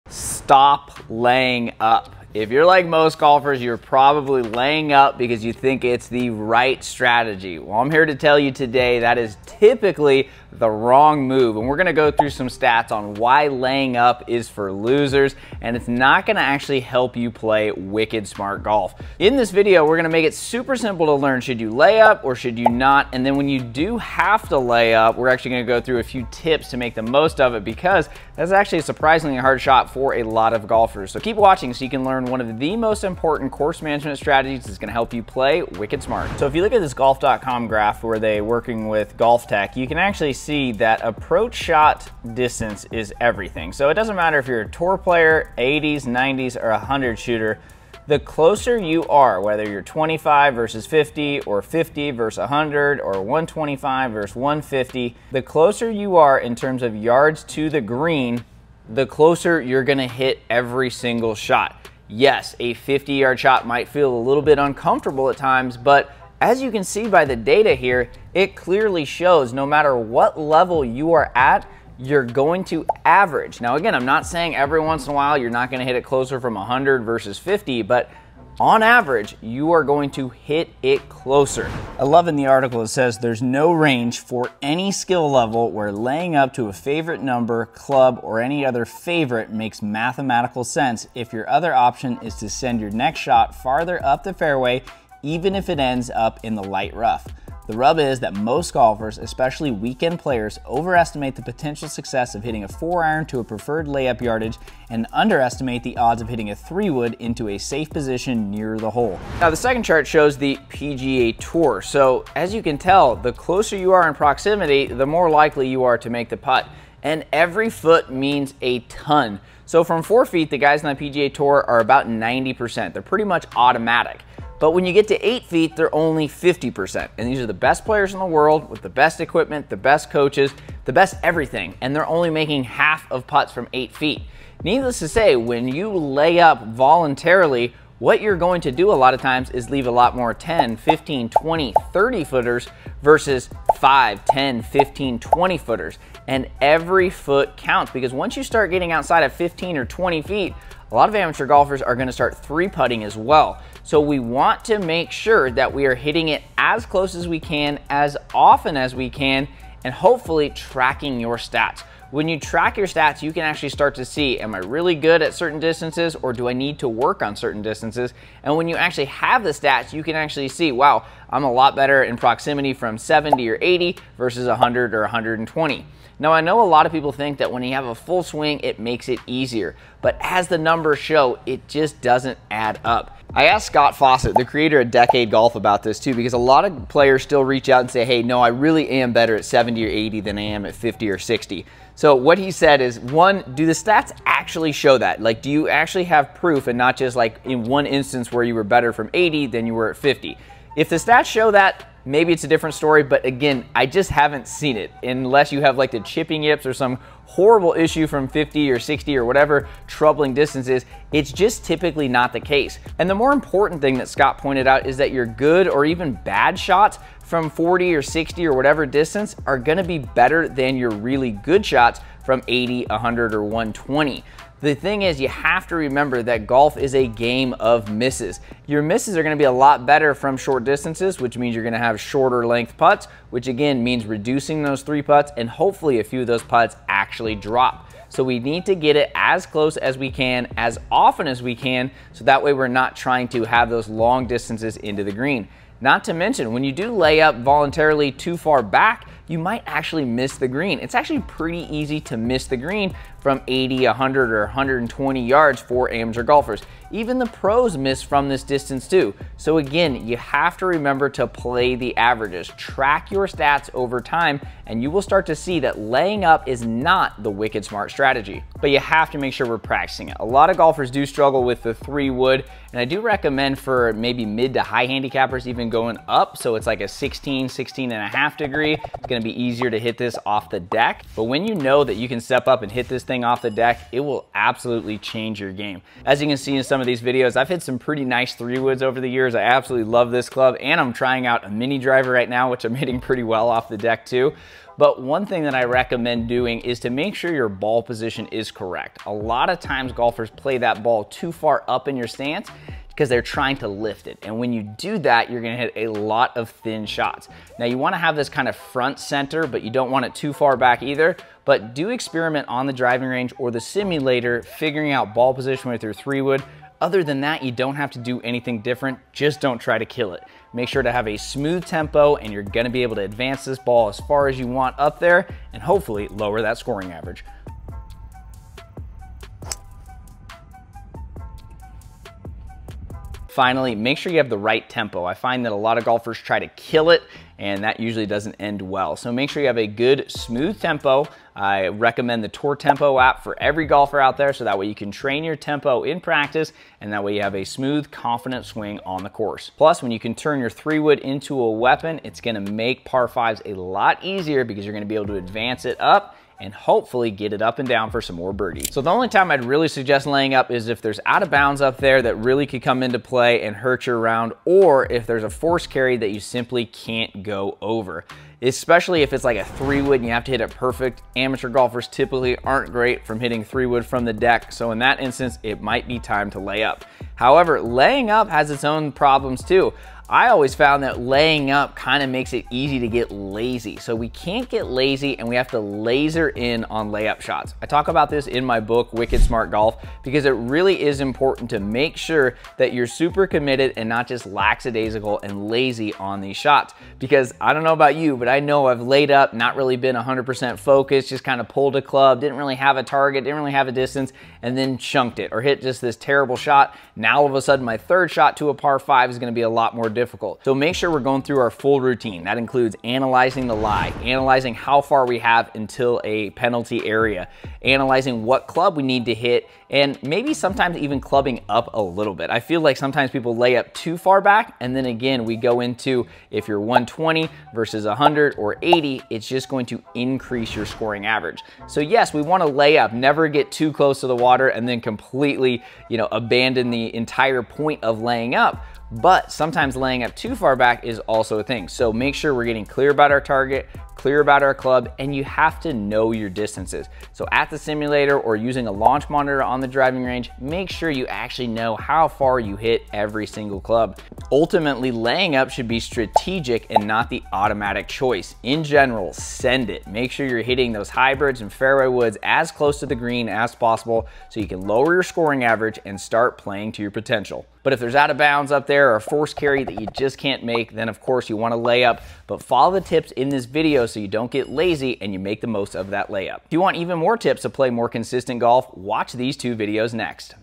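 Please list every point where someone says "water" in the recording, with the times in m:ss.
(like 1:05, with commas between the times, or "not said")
7:14.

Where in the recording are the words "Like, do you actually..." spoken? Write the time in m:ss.
3:15.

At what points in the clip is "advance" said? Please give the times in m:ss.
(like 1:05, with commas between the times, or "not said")
5:23, 5:55.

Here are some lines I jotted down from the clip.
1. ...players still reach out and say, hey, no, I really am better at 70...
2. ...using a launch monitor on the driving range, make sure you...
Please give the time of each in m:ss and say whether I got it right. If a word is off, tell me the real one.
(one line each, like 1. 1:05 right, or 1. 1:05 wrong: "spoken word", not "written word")
1. 3:06 right
2. 7:28 right.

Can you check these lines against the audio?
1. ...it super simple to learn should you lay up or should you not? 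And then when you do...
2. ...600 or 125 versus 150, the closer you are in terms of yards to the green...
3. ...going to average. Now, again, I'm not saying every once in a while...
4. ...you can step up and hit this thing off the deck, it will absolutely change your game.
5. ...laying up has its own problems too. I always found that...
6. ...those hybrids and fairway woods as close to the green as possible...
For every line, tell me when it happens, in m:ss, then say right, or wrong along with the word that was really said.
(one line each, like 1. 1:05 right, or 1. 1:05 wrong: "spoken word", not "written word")
1. 0:20 right
2. 0:52 wrong: "100", not "600"
3. 1:12 right
4. 4:41 right
5. 6:17 right
6. 7:40 right.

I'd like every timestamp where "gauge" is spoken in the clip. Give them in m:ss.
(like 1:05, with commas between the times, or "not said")
not said.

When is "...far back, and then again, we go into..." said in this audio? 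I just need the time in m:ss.
7:03.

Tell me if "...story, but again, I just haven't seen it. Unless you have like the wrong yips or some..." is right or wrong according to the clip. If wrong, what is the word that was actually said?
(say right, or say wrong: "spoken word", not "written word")
wrong: "chipping", not "wrong".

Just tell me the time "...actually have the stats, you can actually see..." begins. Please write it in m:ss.
2:48.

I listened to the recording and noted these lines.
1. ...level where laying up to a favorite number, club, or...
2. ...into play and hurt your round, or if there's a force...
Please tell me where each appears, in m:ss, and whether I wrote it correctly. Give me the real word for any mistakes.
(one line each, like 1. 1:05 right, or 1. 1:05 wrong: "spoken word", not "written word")
1. 1:25 right
2. 6:02 right.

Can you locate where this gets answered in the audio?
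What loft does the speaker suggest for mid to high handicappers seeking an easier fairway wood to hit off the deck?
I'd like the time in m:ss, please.
4:37.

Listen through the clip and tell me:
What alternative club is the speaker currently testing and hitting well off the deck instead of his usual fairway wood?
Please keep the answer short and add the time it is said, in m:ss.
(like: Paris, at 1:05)
mini driver, at 4:51.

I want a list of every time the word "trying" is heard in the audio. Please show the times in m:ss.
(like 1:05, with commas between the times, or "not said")
4:02, 4:50, 5:03.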